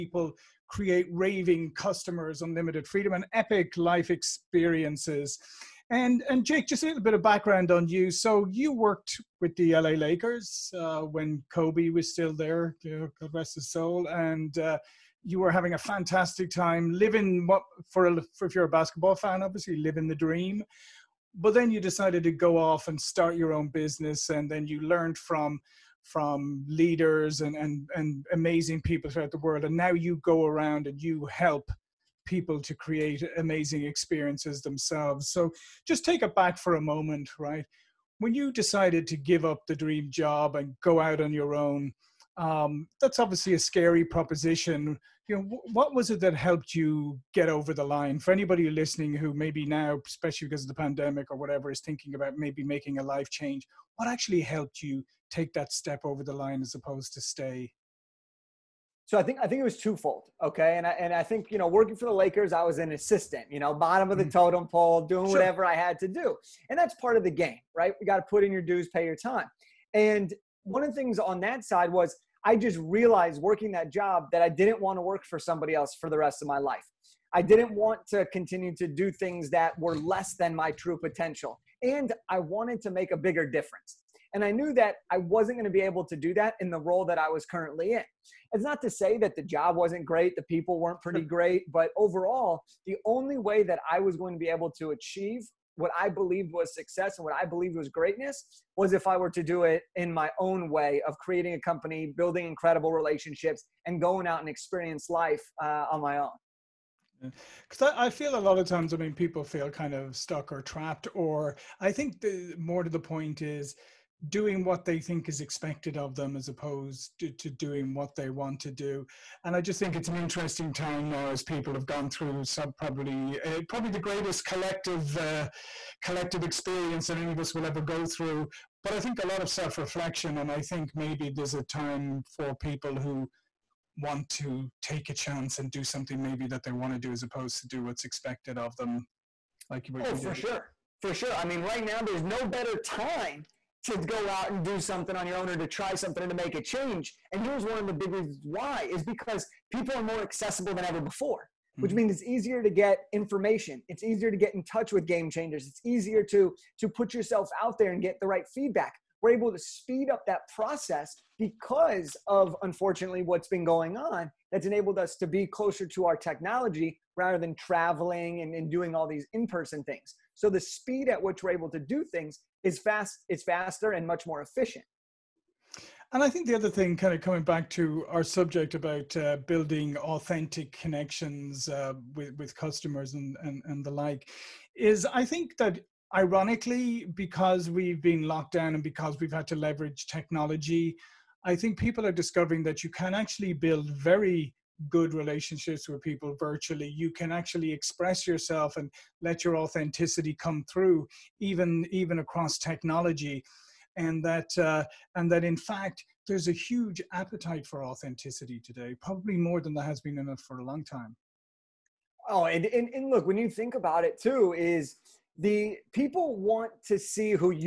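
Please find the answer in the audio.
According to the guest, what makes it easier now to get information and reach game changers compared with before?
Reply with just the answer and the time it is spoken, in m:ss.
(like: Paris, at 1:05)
people are more accessible, at 2:29.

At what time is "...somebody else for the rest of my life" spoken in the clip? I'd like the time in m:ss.
1:15.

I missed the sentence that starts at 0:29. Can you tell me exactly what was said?
And now you go around and you help people to create amazing experiences themselves.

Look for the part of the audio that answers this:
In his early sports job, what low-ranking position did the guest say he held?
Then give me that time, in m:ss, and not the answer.
1:02.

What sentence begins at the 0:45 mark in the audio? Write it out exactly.
You know, what was it that helped you get over the line?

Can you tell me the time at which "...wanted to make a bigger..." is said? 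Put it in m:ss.
1:22.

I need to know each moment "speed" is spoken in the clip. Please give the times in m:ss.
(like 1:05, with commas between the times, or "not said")
2:39, 2:50.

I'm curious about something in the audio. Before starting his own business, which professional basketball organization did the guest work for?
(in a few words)
LA Lakers.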